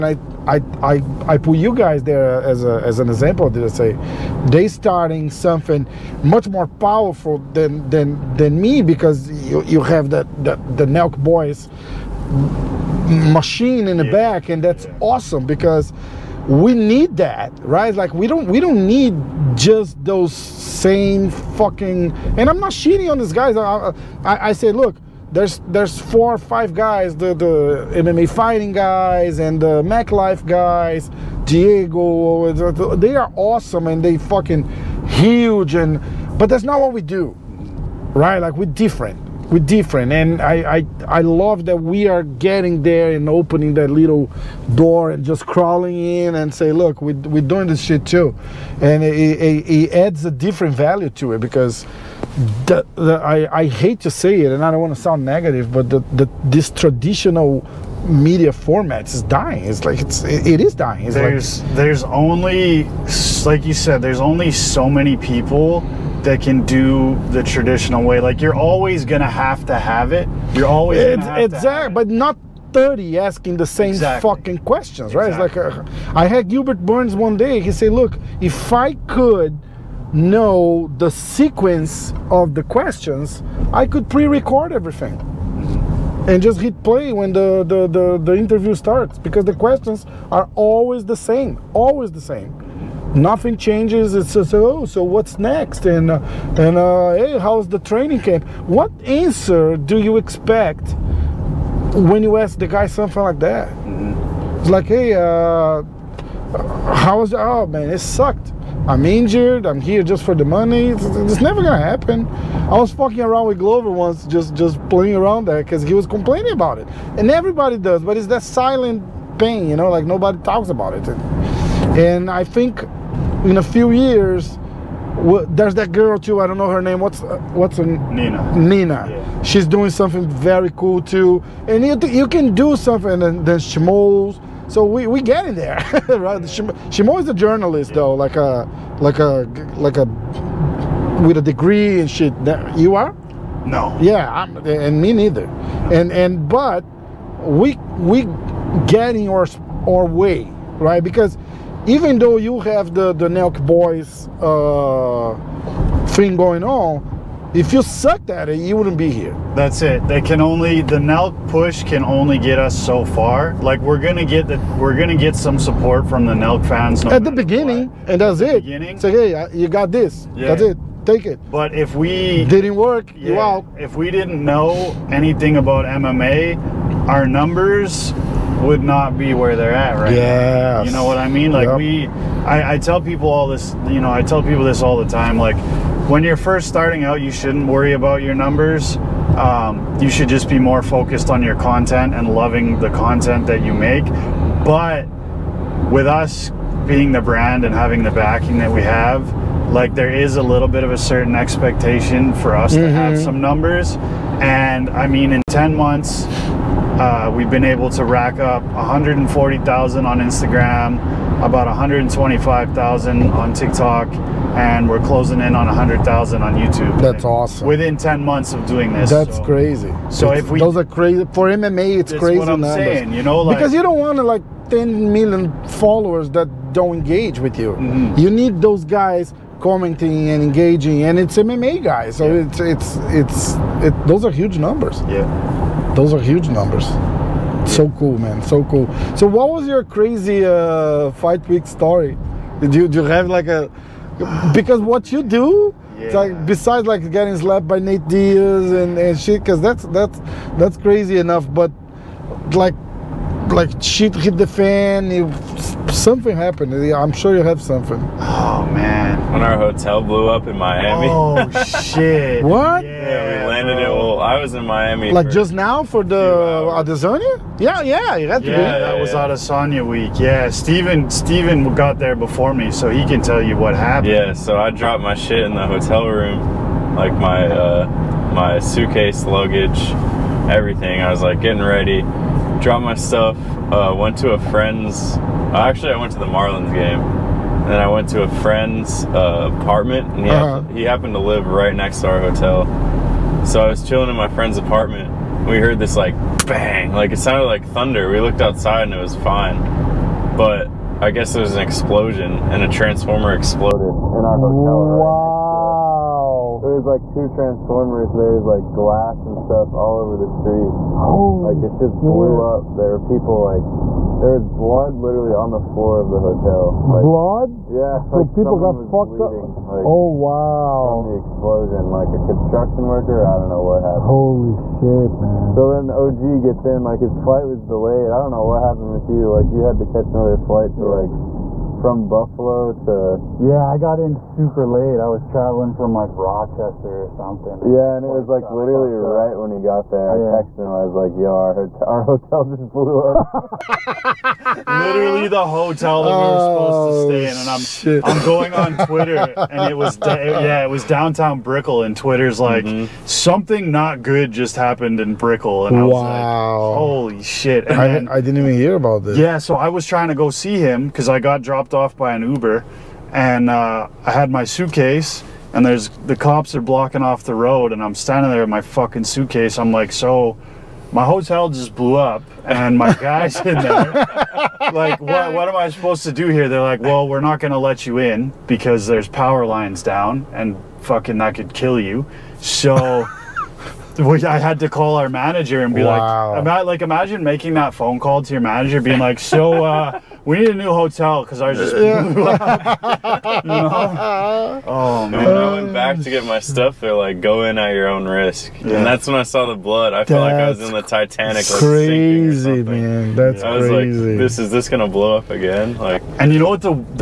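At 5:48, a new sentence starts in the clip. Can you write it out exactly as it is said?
I'm going on Twitter, and it was yeah, it was downtown Brickell, and Twitter's like mm -hmm.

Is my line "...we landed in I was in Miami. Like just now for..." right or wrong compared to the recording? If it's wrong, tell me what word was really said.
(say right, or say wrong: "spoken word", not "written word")
right.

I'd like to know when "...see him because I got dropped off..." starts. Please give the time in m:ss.
6:00.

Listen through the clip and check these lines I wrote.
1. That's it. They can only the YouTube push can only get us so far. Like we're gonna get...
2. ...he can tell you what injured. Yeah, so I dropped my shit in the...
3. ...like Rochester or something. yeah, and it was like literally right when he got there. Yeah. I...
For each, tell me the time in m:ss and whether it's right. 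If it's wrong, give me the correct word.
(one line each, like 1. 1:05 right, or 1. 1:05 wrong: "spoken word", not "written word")
1. 2:39 wrong: "Nelk", not "YouTube"
2. 4:32 wrong: "happened", not "injured"
3. 5:35 right.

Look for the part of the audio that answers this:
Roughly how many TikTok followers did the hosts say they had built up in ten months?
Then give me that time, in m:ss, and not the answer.
3:31.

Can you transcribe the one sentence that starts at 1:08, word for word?
Like you're always gonna have to have it.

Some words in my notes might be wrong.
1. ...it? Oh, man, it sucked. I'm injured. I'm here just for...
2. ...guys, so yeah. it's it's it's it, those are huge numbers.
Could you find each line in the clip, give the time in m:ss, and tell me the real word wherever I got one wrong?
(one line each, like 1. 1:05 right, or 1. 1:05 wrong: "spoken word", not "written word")
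1. 1:47 right
2. 3:51 right.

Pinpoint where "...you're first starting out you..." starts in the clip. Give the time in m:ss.
3:06.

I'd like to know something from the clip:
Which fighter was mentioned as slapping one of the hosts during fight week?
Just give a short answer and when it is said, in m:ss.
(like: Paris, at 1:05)
Nate Diaz, at 4:07.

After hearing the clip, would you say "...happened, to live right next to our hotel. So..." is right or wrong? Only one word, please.
right.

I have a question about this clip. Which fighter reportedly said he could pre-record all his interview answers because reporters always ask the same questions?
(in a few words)
Gilbert Burns.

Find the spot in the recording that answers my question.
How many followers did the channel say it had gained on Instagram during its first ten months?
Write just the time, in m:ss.
3:28.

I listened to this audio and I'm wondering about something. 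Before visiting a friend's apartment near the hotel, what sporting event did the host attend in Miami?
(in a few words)
the Marlins game.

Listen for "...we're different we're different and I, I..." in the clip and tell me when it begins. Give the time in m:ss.
0:38.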